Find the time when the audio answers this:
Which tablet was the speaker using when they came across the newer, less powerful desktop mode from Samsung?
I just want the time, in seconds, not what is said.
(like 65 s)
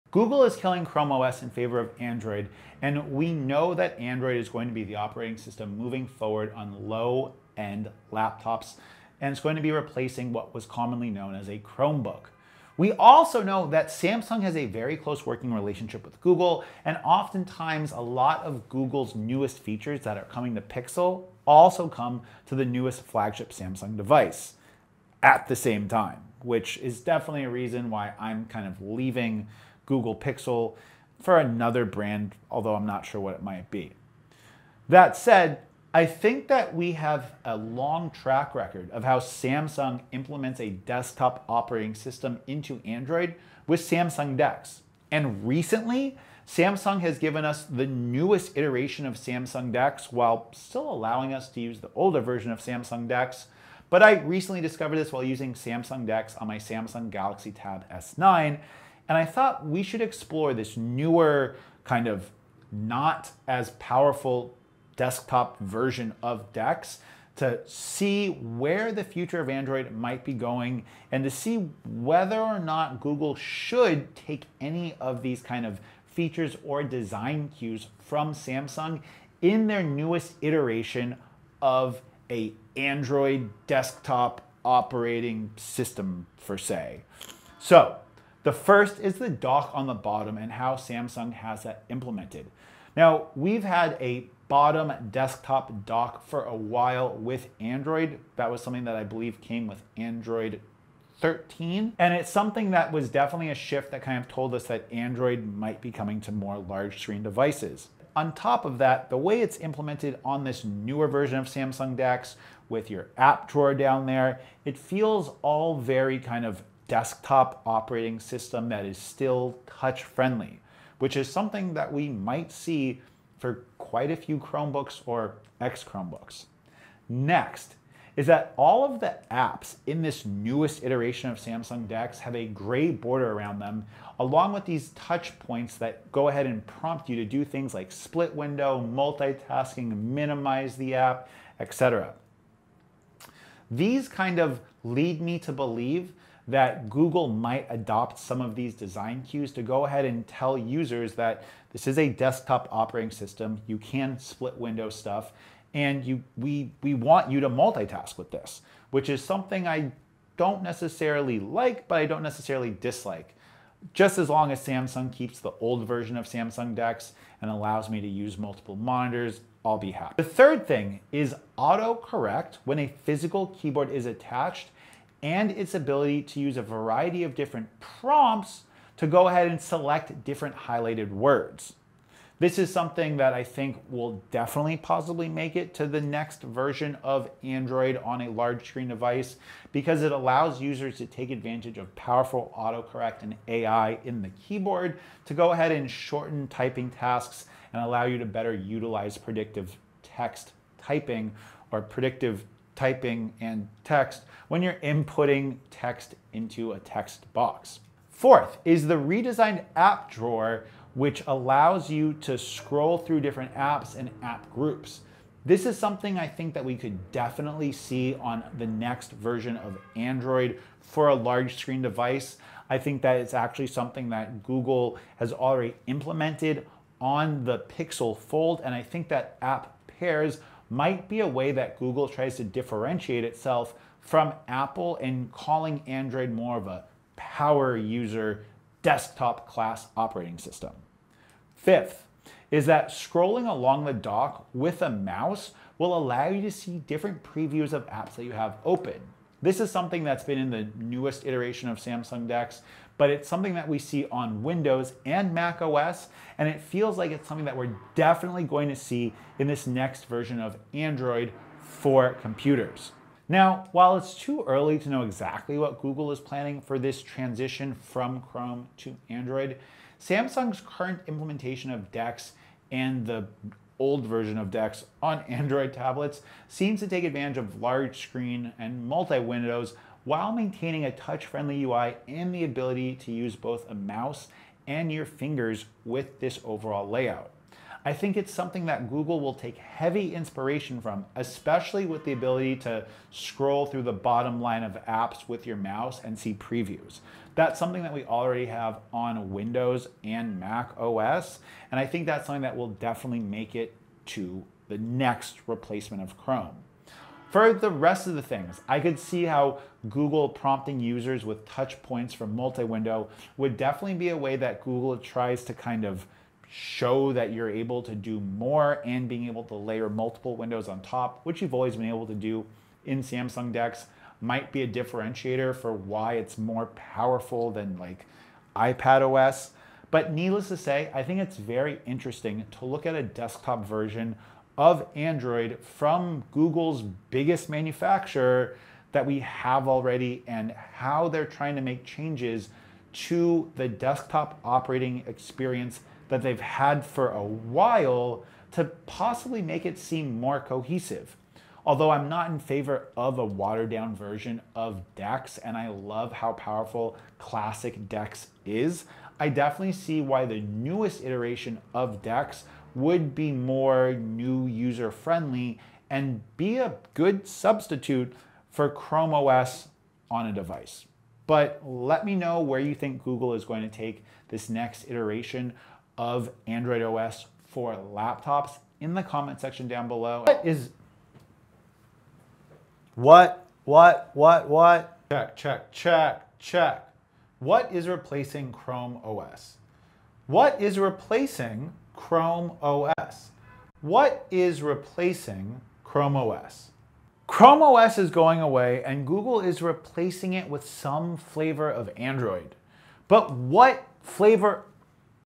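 56 s.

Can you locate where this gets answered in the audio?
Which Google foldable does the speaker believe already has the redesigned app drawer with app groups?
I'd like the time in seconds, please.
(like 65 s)
227 s.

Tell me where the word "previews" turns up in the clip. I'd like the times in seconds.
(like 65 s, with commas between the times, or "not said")
247 s, 296 s.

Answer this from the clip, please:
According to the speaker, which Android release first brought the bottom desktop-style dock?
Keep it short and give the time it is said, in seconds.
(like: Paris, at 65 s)
Android 13, at 99 s.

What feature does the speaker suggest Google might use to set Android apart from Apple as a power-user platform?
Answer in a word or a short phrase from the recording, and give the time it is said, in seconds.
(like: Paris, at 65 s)
App pairs, at 229 s.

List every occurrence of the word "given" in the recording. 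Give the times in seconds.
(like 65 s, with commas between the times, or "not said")
47 s.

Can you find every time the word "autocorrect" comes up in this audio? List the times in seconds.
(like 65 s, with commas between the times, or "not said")
171 s, 192 s.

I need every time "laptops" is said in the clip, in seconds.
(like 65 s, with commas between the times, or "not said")
8 s, 377 s.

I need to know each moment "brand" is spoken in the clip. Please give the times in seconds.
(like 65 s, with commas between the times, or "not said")
31 s.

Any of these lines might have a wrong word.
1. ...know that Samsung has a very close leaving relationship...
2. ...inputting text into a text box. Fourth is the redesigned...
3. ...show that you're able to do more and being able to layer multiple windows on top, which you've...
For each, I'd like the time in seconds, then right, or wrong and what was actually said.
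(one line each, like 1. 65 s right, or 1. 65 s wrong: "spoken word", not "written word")
1. 13 s wrong: "working", not "leaving"
2. 204 s right
3. 316 s right.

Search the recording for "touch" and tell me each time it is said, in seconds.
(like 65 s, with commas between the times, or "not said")
119 s, 134 s, 280 s, 311 s.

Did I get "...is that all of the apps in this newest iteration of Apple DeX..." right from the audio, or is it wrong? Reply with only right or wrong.
wrong.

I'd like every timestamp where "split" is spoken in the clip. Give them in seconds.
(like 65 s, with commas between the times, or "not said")
137 s, 154 s.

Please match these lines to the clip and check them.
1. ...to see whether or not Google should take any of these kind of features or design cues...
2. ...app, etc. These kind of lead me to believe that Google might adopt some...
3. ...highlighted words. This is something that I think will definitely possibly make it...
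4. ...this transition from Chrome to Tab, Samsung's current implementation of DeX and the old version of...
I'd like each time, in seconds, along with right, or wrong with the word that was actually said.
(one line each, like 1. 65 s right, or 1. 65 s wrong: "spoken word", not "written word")
1. 71 s right
2. 140 s right
3. 180 s right
4. 266 s wrong: "Android", not "Tab".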